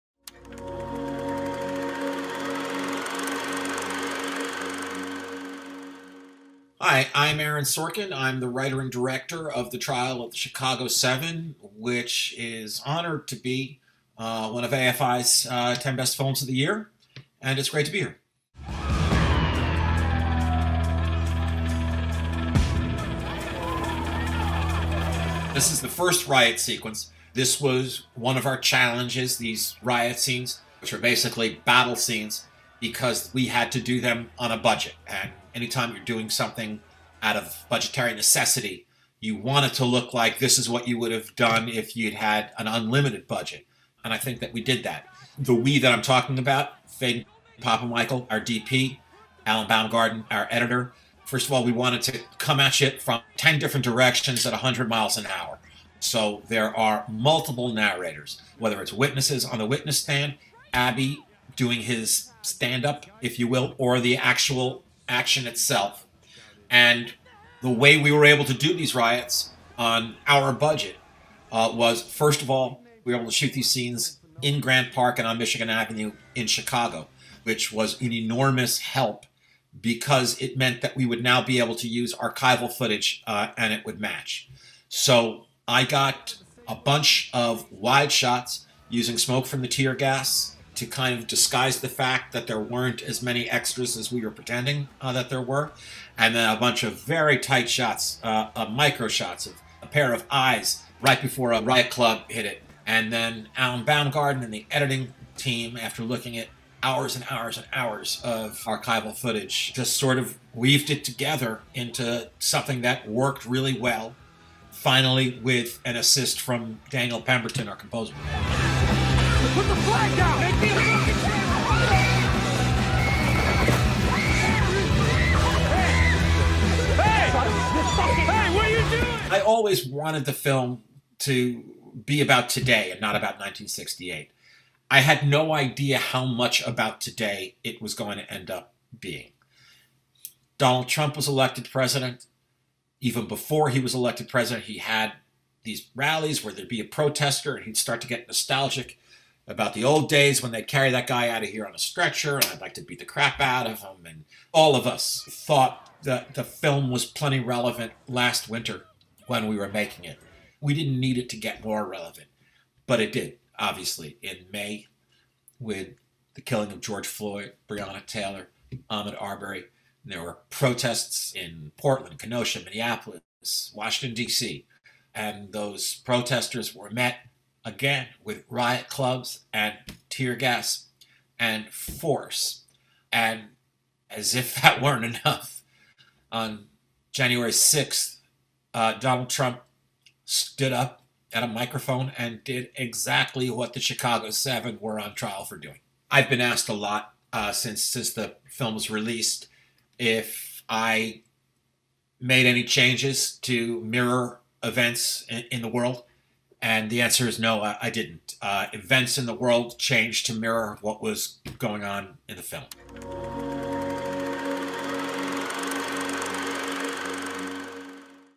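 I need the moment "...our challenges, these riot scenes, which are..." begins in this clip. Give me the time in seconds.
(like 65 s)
28 s.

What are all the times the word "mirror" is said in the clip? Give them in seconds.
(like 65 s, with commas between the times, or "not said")
203 s, 210 s.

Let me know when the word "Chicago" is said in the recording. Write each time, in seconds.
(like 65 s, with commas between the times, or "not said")
10 s, 76 s, 193 s.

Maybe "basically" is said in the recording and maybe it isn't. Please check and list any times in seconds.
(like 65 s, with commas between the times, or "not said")
30 s.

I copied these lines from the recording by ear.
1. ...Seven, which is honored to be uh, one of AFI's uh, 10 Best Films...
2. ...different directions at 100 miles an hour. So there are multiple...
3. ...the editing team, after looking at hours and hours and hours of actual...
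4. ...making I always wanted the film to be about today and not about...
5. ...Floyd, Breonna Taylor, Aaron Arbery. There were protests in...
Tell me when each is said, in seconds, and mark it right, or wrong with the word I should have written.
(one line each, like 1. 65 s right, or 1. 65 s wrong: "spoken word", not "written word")
1. 10 s right
2. 53 s right
3. 104 s wrong: "archival", not "actual"
4. 127 s wrong: "fucking", not "making"
5. 167 s wrong: "Ahmaud", not "Aaron".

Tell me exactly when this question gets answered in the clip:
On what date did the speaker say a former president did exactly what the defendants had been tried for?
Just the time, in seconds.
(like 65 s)
187 s.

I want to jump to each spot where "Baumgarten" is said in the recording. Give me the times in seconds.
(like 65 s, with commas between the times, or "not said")
49 s, 103 s.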